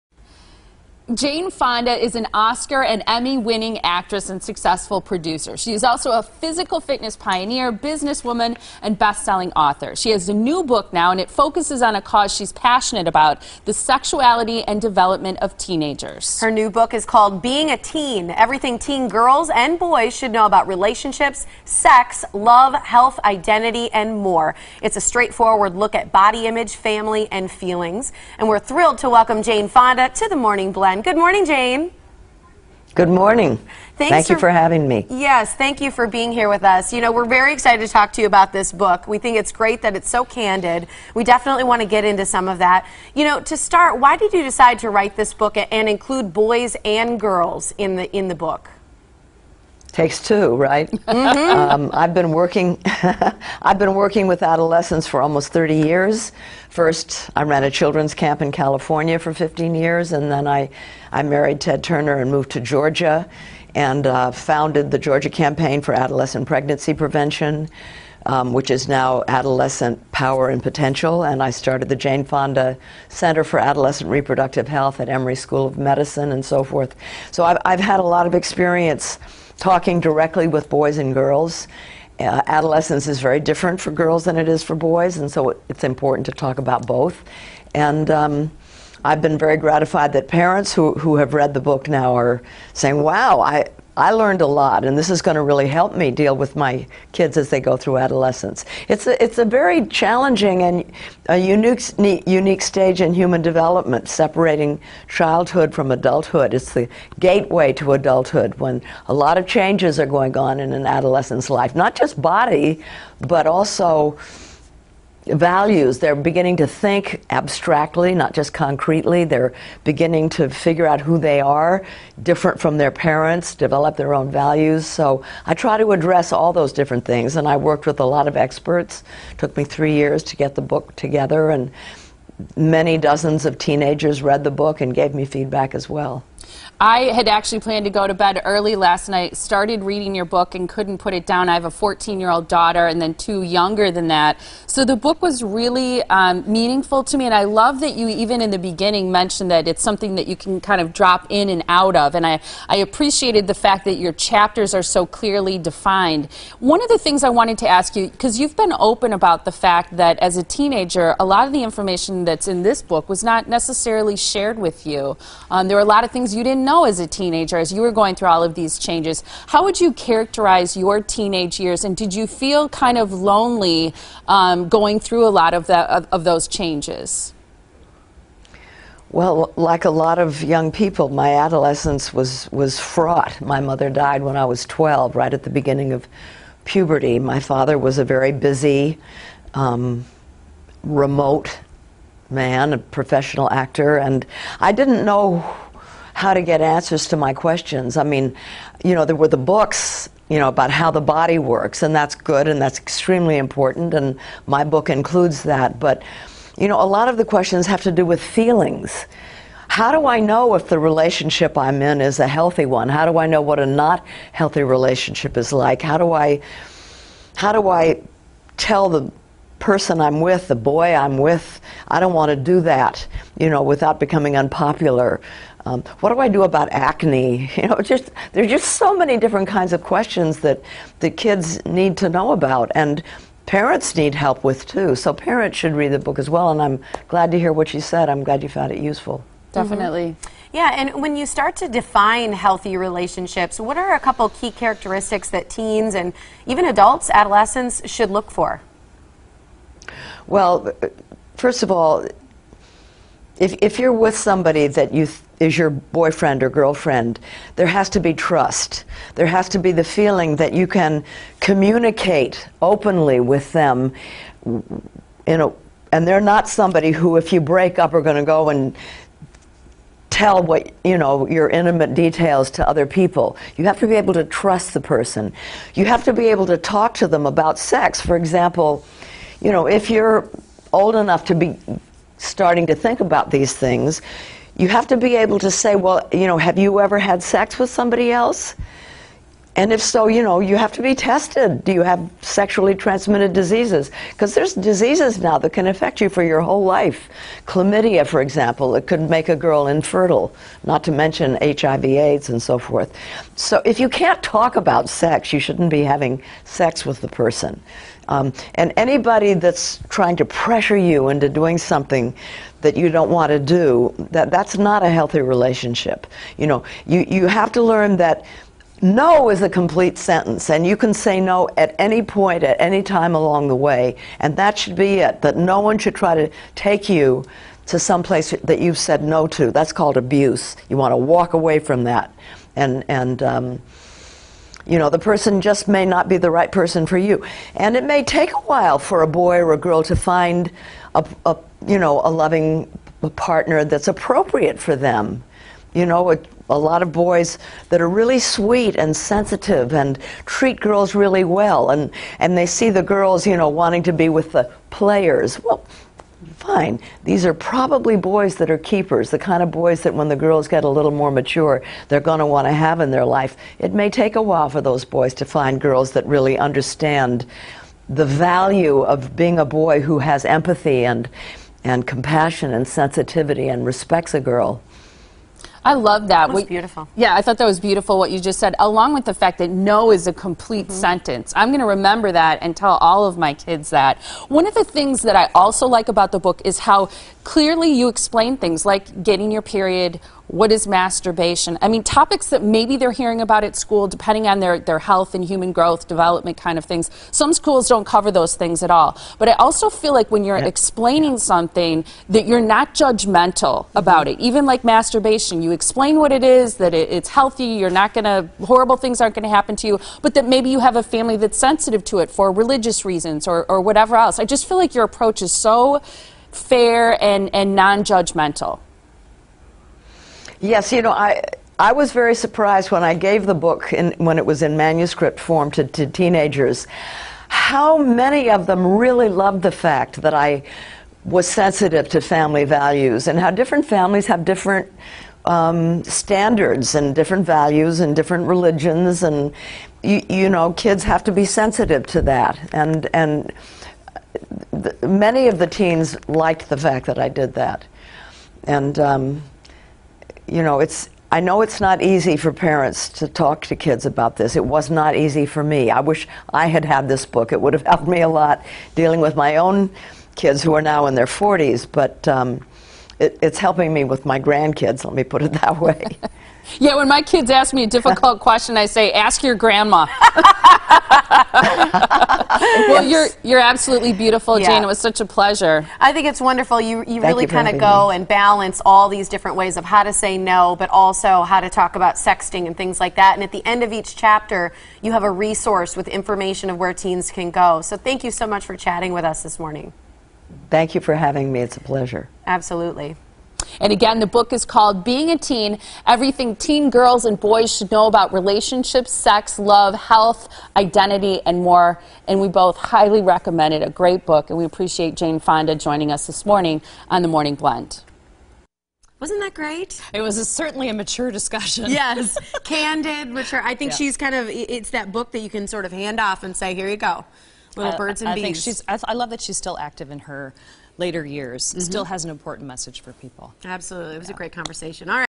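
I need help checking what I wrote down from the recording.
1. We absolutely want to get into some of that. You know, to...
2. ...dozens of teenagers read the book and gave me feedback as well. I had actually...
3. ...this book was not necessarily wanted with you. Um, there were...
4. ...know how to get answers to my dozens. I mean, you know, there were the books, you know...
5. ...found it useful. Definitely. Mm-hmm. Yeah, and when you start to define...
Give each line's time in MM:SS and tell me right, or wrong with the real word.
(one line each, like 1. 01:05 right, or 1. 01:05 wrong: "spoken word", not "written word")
1. 00:41 wrong: "definitely", not "absolutely"
2. 02:12 right
3. 02:42 wrong: "shared", not "wanted"
4. 03:15 wrong: "questions", not "dozens"
5. 03:58 right.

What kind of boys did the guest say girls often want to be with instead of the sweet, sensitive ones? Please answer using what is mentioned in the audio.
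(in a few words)
players.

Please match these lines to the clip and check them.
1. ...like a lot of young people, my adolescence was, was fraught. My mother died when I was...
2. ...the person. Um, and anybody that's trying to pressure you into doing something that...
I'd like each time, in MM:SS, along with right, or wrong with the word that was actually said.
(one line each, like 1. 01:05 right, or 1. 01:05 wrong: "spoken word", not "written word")
1. 02:59 right
2. 05:07 right.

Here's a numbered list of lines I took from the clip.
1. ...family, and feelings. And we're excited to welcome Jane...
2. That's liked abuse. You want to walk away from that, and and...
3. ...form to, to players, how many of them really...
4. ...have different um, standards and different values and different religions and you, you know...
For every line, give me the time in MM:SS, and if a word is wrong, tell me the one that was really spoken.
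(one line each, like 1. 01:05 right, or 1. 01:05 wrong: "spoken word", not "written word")
1. 00:26 wrong: "thrilled", not "excited"
2. 05:29 wrong: "called", not "liked"
3. 07:05 wrong: "teenagers", not "players"
4. 07:14 right.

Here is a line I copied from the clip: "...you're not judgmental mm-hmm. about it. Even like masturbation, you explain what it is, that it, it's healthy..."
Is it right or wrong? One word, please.
right.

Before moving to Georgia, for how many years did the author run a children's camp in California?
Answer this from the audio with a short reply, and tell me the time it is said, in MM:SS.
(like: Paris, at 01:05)
15, at 00:59.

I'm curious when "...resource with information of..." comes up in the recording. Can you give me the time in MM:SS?
08:05.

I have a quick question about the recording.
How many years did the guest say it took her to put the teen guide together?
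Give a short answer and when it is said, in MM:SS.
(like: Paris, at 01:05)
3, at 02:09.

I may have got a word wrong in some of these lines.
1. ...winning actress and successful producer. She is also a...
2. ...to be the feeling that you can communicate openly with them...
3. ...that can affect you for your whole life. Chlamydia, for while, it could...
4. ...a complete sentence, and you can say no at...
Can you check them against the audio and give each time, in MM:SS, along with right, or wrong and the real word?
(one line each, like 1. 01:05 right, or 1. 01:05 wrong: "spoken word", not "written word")
1. 00:03 right
2. 04:19 right
3. 04:55 wrong: "example", not "while"
4. 05:19 right.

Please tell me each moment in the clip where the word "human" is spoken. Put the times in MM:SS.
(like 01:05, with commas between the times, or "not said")
01:43, 06:35.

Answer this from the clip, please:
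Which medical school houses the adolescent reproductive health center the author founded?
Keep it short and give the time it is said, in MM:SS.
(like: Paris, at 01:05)
Emory School of Medicine, at 01:15.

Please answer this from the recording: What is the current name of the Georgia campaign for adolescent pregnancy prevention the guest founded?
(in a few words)
Adolescent Power and Potential.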